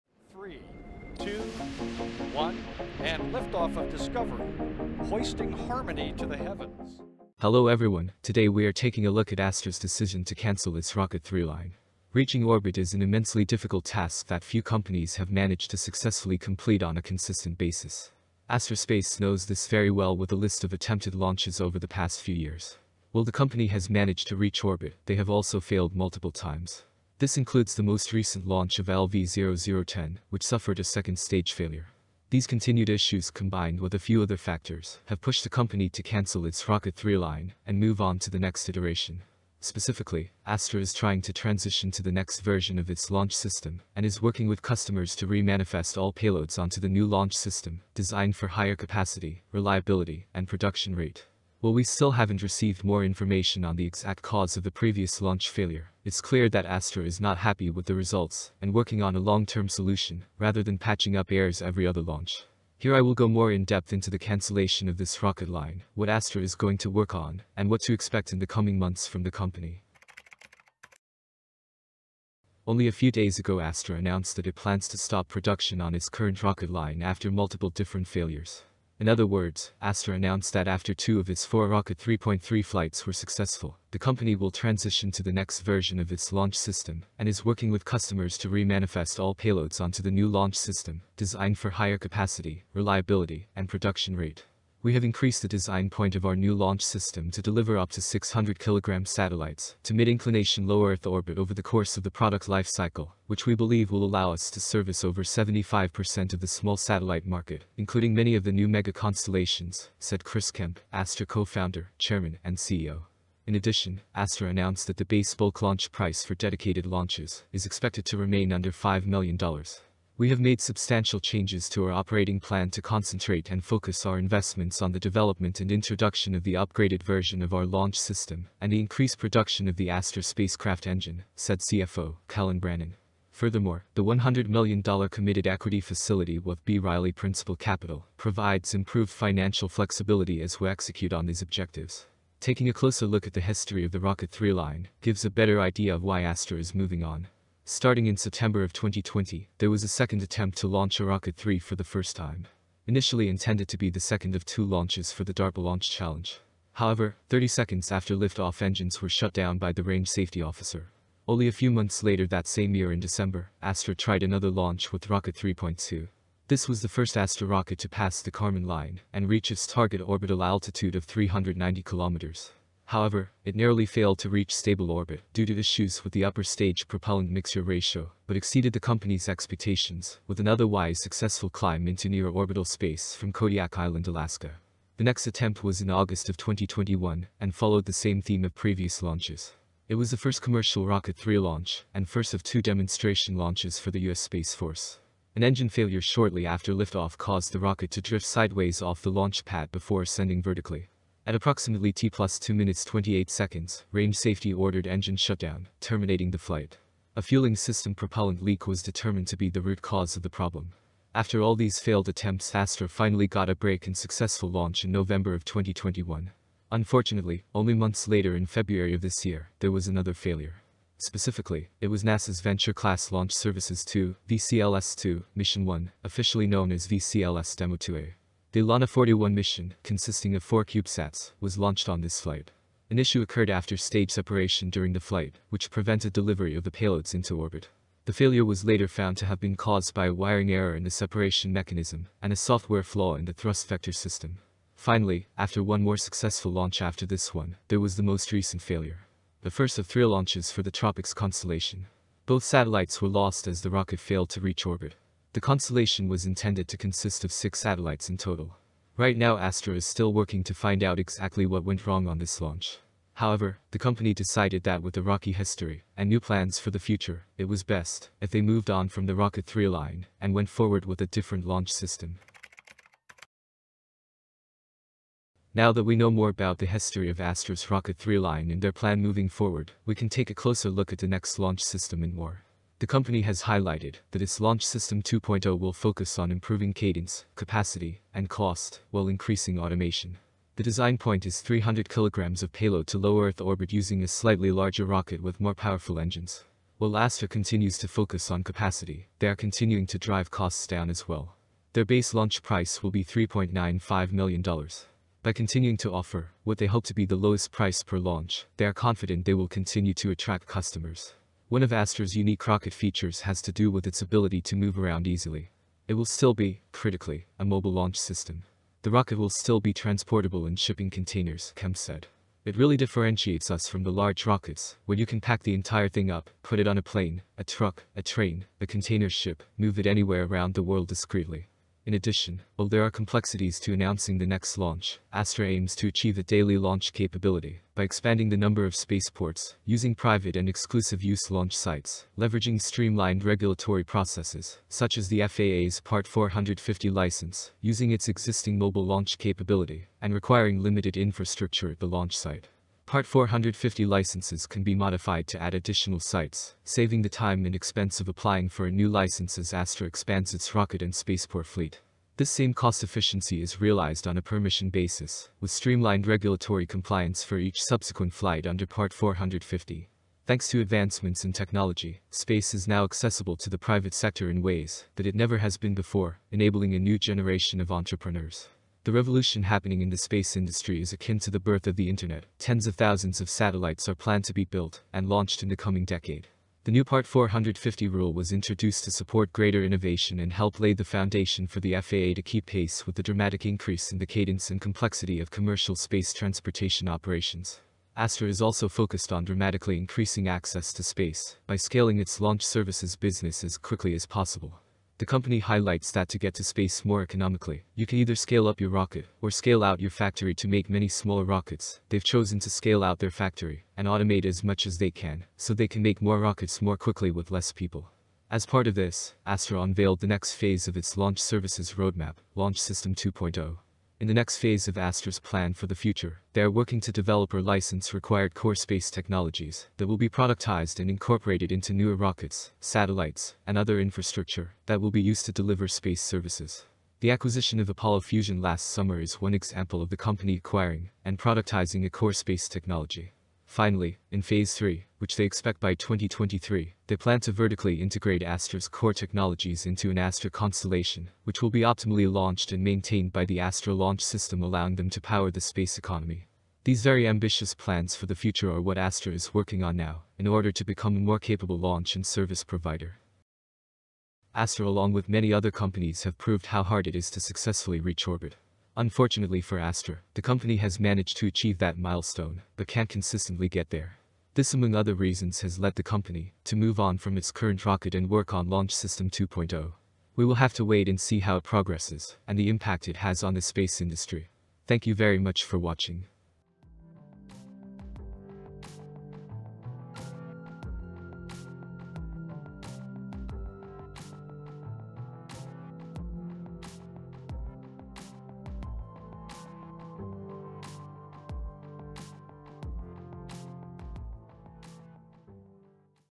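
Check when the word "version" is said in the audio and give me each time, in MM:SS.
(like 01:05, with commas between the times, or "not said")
00:42, 01:25, 02:07.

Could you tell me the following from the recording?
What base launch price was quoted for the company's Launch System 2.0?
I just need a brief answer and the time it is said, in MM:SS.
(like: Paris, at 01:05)
$3.95 million, at 05:03.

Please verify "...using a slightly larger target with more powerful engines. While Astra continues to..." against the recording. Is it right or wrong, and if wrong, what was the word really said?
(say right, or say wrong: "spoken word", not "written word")
wrong: "rocket", not "target".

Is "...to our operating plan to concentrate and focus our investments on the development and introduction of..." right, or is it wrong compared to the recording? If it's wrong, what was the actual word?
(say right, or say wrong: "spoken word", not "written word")
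right.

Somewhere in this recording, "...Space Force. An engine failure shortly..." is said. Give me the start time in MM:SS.
03:14.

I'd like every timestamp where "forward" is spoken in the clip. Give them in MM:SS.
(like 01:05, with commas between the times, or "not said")
04:30, 04:39.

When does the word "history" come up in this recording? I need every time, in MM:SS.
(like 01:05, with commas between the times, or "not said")
02:23, 04:25, 04:36.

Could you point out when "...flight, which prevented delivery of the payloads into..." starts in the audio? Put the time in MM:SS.
03:54.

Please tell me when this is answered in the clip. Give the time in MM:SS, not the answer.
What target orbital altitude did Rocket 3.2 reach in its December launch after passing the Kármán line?
02:51.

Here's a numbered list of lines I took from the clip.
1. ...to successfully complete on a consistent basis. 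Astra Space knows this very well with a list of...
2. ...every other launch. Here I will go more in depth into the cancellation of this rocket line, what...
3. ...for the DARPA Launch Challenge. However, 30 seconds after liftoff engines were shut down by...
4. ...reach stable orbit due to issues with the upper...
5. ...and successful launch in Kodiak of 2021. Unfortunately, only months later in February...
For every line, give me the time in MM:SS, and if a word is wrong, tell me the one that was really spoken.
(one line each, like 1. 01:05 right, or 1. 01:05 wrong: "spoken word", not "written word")
1. 00:15 right
2. 01:01 right
3. 02:35 right
4. 02:54 right
5. 03:33 wrong: "November", not "Kodiak".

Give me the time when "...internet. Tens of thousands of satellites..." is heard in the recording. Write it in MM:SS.
06:21.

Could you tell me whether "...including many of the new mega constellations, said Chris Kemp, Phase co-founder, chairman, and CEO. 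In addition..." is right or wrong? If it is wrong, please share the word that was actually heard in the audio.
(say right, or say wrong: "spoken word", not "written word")
wrong: "Astra", not "Phase".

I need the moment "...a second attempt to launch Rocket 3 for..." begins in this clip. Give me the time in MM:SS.
02:29.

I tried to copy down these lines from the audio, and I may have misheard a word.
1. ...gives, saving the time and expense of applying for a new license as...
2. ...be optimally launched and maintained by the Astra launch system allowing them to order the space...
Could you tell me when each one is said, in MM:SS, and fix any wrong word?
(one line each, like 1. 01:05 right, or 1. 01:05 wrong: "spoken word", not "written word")
1. 05:56 wrong: "sites", not "gives"
2. 07:31 wrong: "power", not "order".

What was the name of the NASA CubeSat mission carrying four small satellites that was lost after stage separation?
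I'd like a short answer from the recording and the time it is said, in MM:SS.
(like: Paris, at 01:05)
ELaNa 41, at 03:48.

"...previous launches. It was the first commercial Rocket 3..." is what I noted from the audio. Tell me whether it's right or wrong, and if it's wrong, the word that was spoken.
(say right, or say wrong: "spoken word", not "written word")
right.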